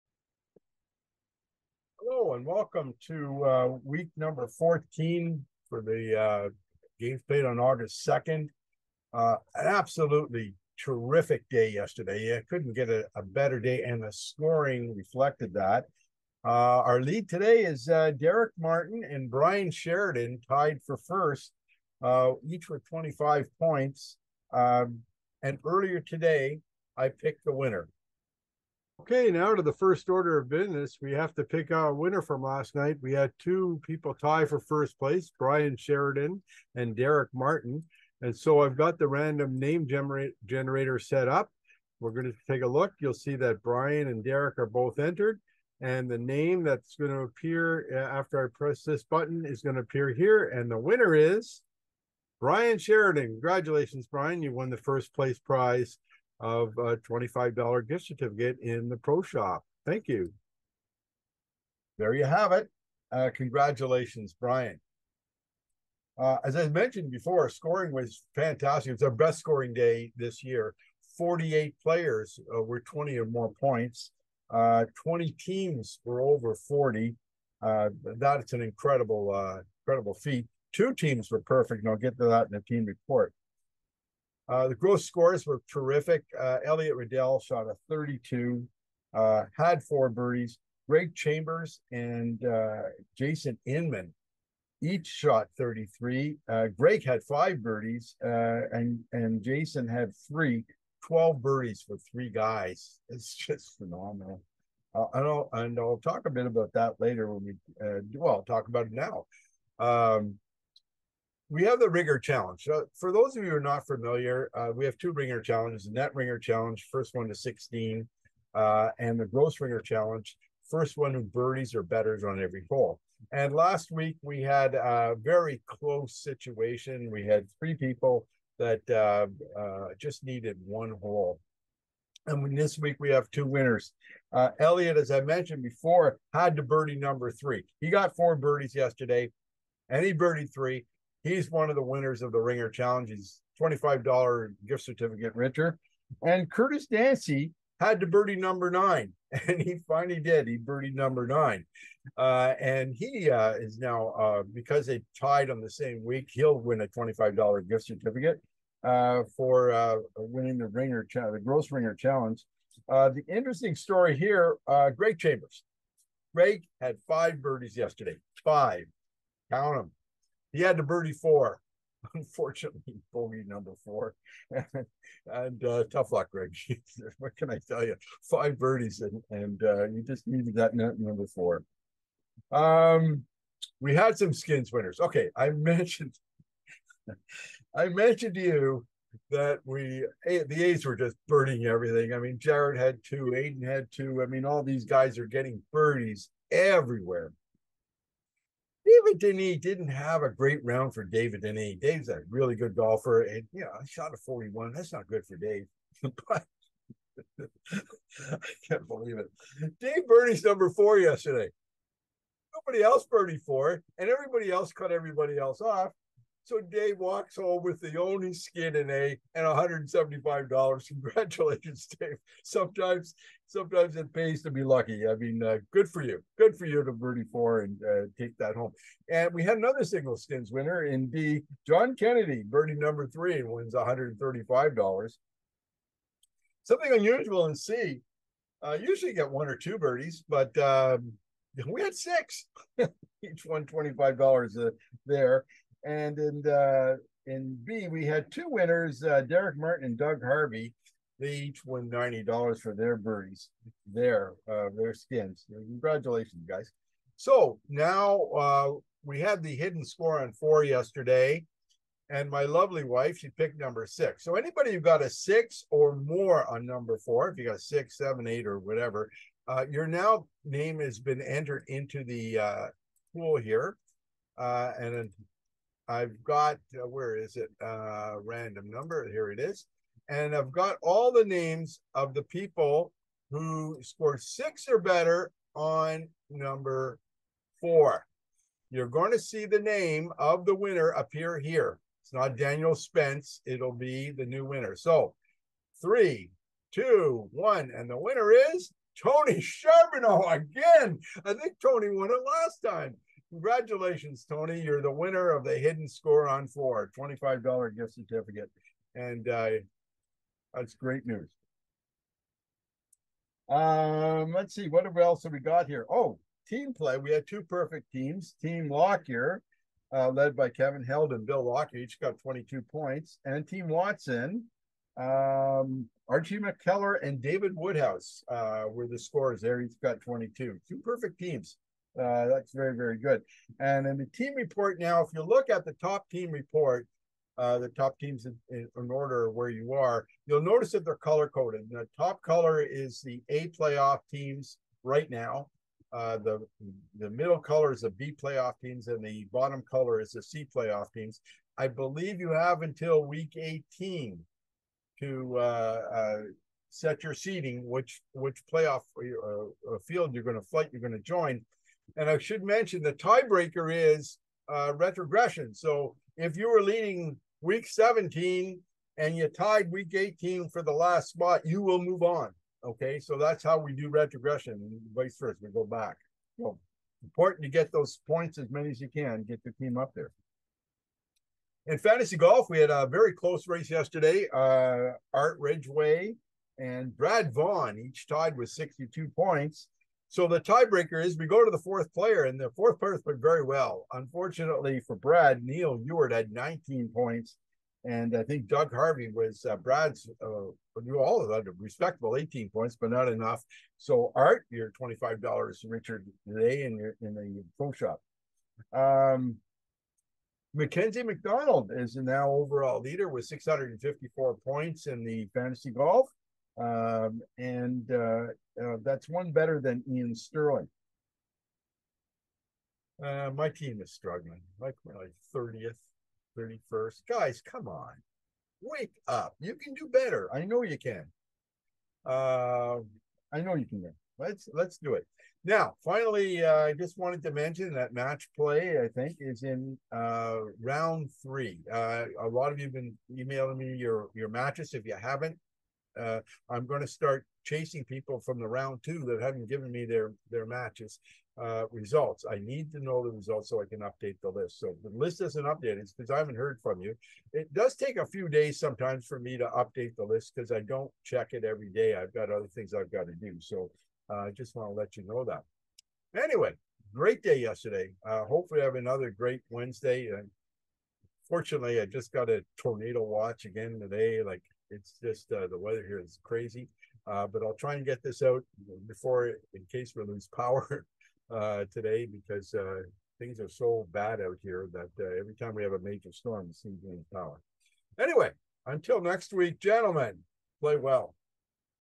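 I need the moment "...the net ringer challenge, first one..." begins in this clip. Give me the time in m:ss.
1:55.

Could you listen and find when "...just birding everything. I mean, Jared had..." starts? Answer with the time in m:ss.
3:10.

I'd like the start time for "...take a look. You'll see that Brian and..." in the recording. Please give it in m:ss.
0:42.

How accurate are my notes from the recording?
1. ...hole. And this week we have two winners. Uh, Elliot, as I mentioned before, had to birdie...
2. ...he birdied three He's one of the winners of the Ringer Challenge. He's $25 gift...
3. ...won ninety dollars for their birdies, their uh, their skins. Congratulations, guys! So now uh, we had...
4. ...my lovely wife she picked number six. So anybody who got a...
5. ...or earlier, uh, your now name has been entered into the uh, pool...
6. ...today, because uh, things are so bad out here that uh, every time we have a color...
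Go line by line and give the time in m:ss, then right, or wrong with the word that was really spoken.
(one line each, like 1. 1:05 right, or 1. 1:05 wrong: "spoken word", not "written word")
1. 2:11 right
2. 2:20 right
3. 4:11 right
4. 4:22 right
5. 4:28 wrong: "whatever", not "earlier"
6. 8:01 wrong: "major", not "color".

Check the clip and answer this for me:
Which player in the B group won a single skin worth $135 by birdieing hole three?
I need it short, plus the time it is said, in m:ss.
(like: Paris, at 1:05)
John Kennedy, at 3:51.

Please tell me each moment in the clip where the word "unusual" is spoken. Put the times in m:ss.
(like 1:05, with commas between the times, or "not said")
3:56.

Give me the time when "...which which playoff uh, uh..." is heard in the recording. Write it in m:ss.
5:57.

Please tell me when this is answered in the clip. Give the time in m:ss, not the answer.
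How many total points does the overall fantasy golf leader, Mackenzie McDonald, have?
6:53.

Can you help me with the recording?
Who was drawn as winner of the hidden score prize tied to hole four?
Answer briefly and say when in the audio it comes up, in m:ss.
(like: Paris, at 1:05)
Tony Charbonneau, at 4:59.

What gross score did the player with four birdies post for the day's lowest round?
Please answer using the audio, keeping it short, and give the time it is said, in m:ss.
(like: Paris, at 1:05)
32, at 1:27.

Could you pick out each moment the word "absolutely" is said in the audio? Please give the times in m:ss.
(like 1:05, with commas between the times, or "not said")
0:09.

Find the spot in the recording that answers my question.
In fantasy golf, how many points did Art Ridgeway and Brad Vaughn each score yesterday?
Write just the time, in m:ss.
6:28.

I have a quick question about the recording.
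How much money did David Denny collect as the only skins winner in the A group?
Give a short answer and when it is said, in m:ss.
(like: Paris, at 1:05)
$175, at 3:39.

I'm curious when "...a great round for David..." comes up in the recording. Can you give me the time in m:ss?
3:20.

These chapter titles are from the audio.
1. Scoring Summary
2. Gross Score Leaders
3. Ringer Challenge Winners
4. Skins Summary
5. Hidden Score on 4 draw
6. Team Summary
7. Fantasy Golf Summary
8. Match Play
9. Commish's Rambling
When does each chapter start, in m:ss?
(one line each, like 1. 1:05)
1. 1:06
2. 1:24
3. 1:50
4. 3:04
5. 4:19
6. 5:16
7. 6:20
8. 7:16
9. 7:49.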